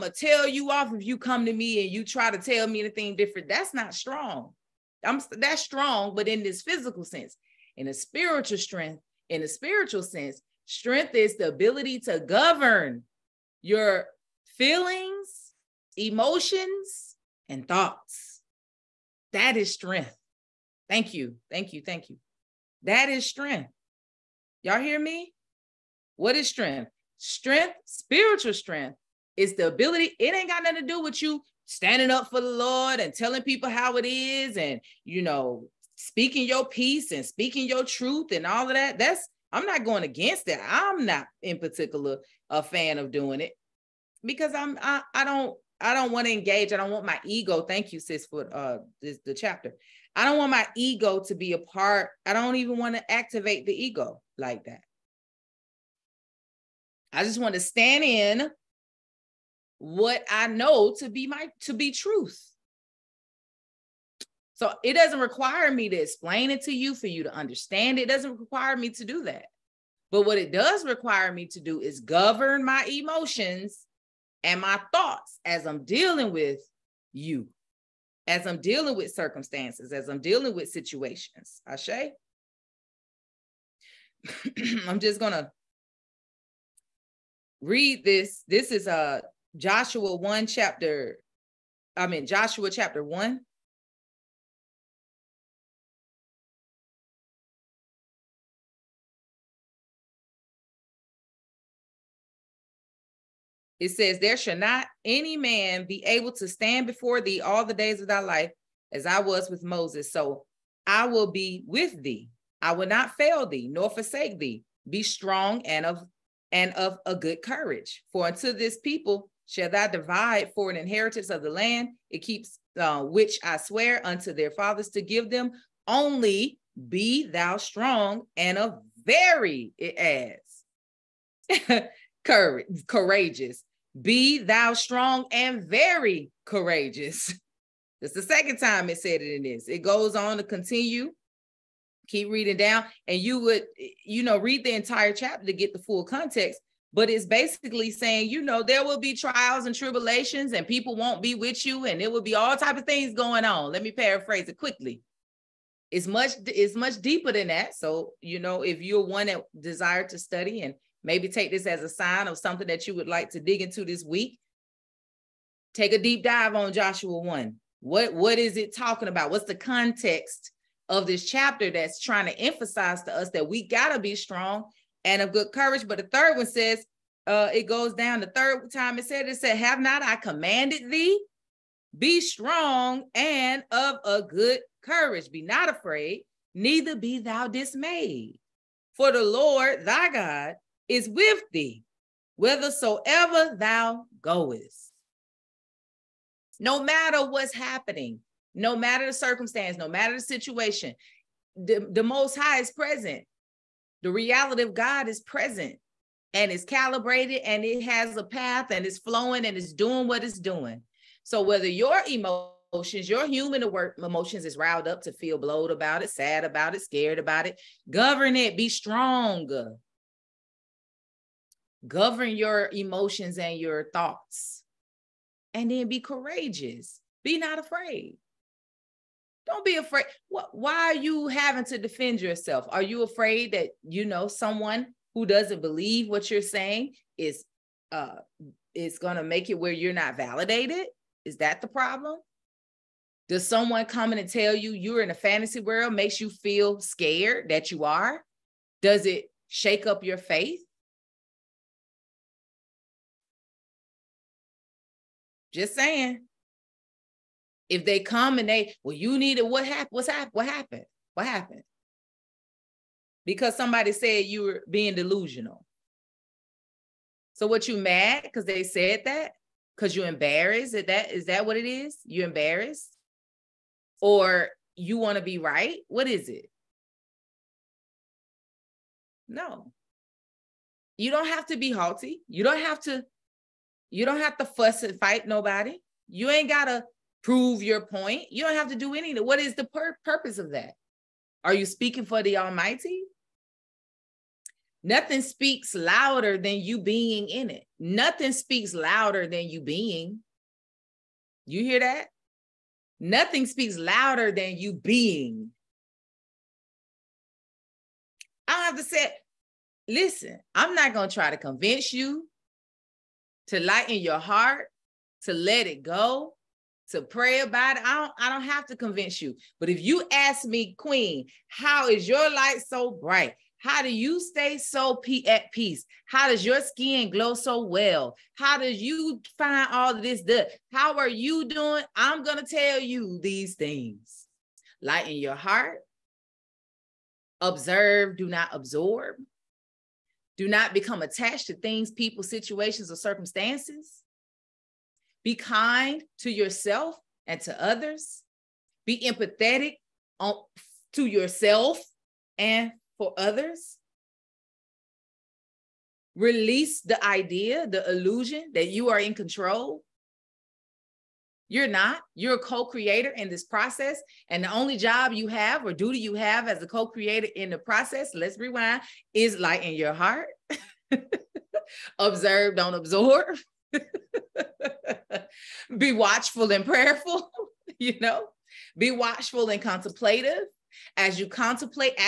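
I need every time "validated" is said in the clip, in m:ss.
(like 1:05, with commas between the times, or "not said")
4:00.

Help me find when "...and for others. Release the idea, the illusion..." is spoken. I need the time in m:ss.
5:52.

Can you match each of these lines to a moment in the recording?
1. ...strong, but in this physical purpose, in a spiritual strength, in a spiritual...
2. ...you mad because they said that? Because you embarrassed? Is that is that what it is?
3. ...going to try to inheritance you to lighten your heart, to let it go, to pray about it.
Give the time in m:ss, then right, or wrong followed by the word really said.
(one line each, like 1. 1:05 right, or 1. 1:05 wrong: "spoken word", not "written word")
1. 0:05 wrong: "sense", not "purpose"
2. 4:27 right
3. 5:10 wrong: "convince", not "inheritance".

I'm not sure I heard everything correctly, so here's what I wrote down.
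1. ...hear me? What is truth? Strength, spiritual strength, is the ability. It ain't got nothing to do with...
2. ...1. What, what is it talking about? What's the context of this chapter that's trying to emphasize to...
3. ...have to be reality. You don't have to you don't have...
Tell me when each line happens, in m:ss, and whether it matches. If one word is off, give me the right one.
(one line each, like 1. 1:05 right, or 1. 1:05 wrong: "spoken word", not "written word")
1. 0:24 wrong: "strength", not "truth"
2. 2:47 right
3. 4:41 wrong: "haughty", not "reality".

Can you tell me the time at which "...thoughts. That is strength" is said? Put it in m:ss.
0:17.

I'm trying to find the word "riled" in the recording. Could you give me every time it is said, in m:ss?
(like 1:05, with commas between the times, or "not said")
3:34.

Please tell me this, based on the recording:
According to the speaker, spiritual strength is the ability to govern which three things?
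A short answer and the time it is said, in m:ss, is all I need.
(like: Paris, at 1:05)
Feelings, emotions, and thoughts, at 0:14.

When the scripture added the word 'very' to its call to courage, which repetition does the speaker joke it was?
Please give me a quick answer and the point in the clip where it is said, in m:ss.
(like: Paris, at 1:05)
Second, at 2:18.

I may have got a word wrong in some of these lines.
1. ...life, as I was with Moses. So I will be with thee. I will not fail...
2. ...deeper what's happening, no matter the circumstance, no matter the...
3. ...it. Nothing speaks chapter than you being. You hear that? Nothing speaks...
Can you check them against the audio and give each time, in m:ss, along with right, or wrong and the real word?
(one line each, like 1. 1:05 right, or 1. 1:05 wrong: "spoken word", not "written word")
1. 1:48 right
2. 3:16 wrong: "matter", not "deeper"
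3. 4:57 wrong: "louder", not "chapter".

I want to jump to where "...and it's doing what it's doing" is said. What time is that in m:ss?
3:29.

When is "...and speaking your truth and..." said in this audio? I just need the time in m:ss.
0:37.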